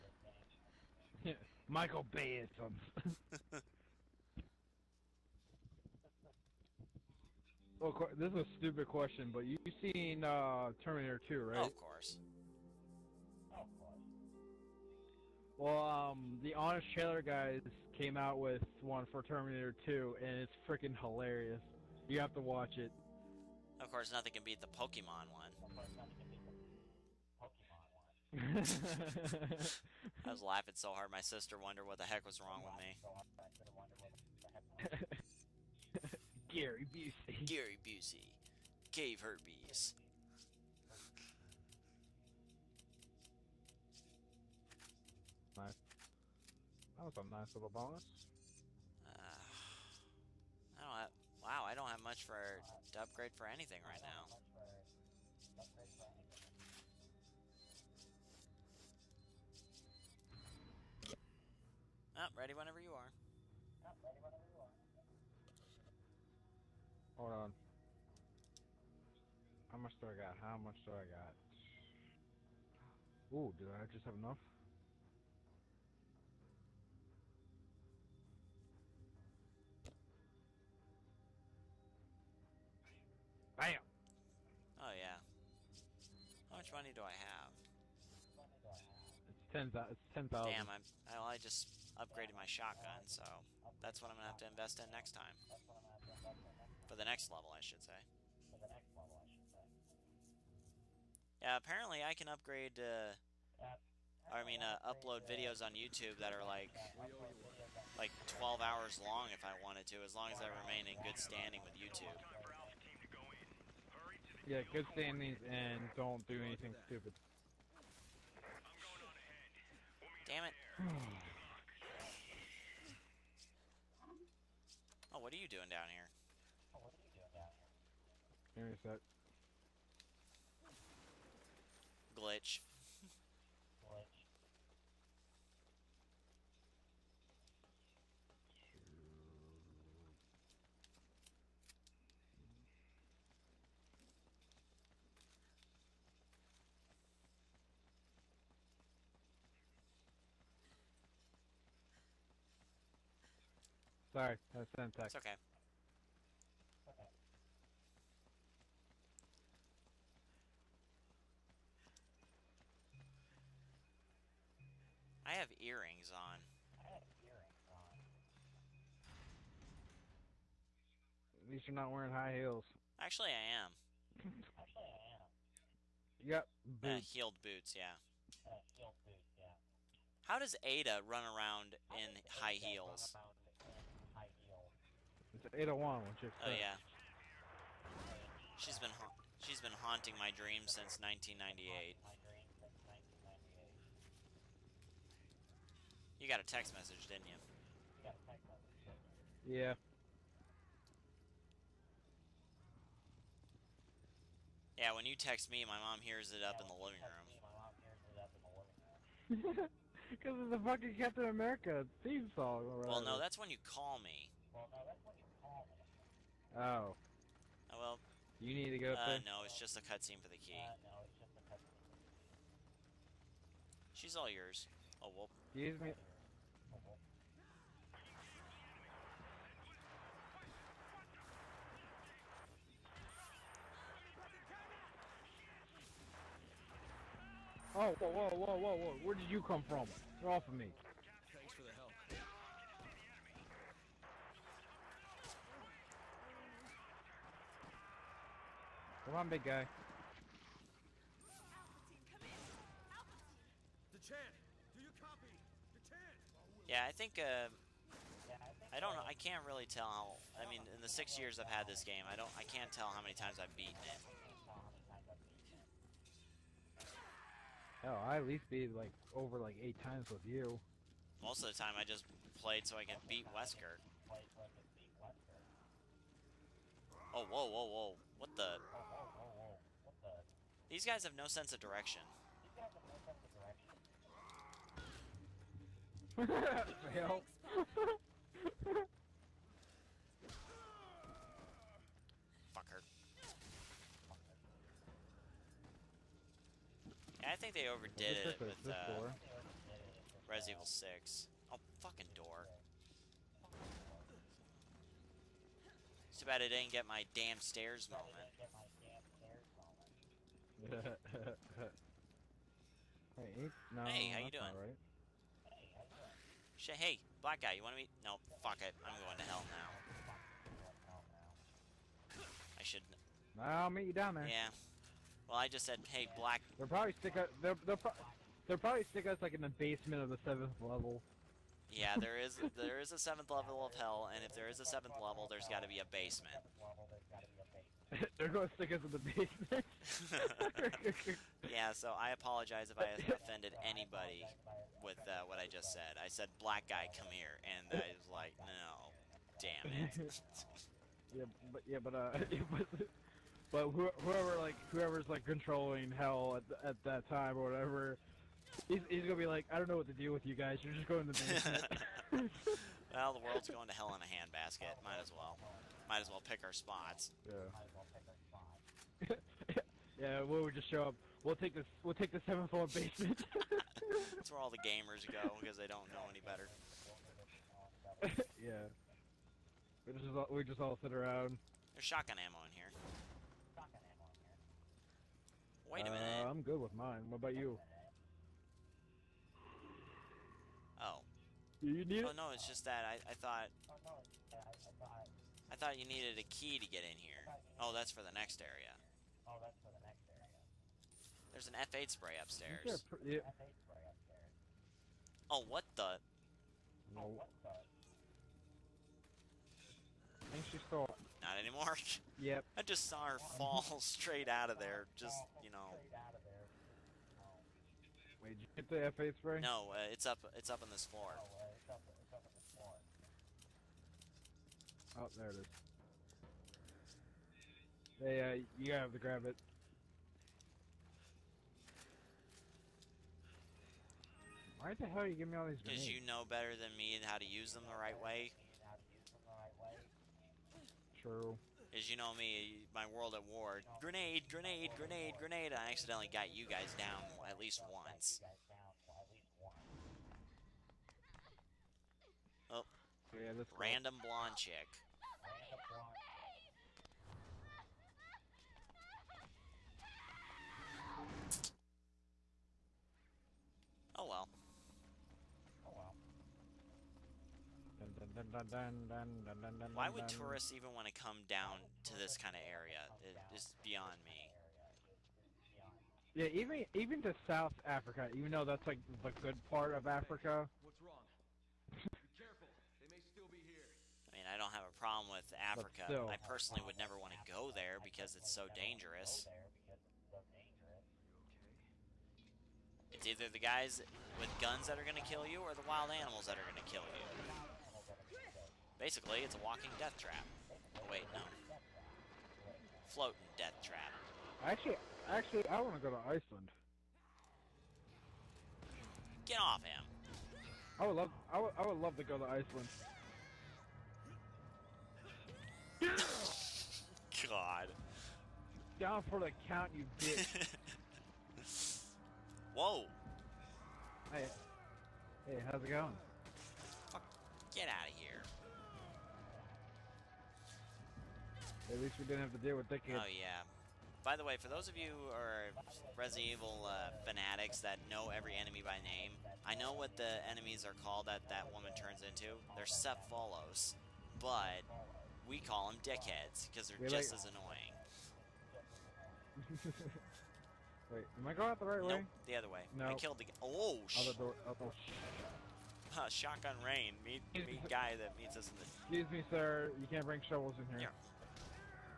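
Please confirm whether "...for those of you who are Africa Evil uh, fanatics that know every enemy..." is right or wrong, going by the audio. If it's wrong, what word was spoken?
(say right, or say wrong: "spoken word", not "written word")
wrong: "Resident", not "Africa".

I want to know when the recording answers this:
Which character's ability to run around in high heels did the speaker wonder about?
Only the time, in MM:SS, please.
03:00.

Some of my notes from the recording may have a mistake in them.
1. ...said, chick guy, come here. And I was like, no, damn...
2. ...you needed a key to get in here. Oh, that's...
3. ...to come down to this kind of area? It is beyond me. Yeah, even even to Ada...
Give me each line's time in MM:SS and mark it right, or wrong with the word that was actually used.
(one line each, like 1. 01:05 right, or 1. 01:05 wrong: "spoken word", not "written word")
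1. 05:46 wrong: "black", not "chick"
2. 06:35 right
3. 07:50 wrong: "South", not "Ada".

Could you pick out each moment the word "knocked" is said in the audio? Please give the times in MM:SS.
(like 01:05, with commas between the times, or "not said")
not said.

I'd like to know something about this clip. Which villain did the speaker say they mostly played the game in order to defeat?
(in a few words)
Wesker.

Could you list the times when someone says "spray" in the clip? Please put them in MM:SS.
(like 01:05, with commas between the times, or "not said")
06:41, 06:59.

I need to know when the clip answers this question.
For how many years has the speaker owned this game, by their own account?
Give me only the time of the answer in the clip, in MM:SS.
04:20.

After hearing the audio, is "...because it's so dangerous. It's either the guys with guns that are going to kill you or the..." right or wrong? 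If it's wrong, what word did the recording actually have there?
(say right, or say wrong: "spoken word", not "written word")
right.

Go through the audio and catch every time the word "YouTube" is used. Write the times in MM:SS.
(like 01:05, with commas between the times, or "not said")
01:45, 01:51.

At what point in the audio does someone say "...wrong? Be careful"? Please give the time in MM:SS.
08:00.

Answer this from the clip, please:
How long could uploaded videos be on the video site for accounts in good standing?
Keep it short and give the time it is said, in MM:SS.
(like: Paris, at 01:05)
12 hours, at 01:48.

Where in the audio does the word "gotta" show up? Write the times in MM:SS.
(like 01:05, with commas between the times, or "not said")
07:08.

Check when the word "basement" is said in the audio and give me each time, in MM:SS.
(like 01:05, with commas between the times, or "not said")
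05:29, 05:35, 05:40, 06:02, 06:12.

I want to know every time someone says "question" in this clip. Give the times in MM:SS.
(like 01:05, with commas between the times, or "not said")
00:08.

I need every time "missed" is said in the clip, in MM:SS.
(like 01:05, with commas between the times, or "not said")
not said.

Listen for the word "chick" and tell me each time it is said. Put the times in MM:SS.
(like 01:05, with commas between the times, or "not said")
07:34.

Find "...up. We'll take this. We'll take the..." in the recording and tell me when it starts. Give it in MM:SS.
06:10.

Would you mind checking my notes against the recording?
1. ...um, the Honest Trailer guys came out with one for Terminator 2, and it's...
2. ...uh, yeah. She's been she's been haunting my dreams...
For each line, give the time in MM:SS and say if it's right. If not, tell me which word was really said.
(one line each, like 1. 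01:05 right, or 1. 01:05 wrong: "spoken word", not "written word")
1. 00:15 right
2. 03:06 right.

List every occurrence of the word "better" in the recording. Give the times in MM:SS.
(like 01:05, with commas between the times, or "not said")
06:16, 07:16.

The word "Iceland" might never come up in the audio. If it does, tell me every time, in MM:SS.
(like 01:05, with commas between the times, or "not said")
08:26, 08:32.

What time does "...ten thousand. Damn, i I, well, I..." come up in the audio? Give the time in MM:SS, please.
01:29.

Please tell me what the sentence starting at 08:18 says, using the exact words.
Basically, it's a walking death trap.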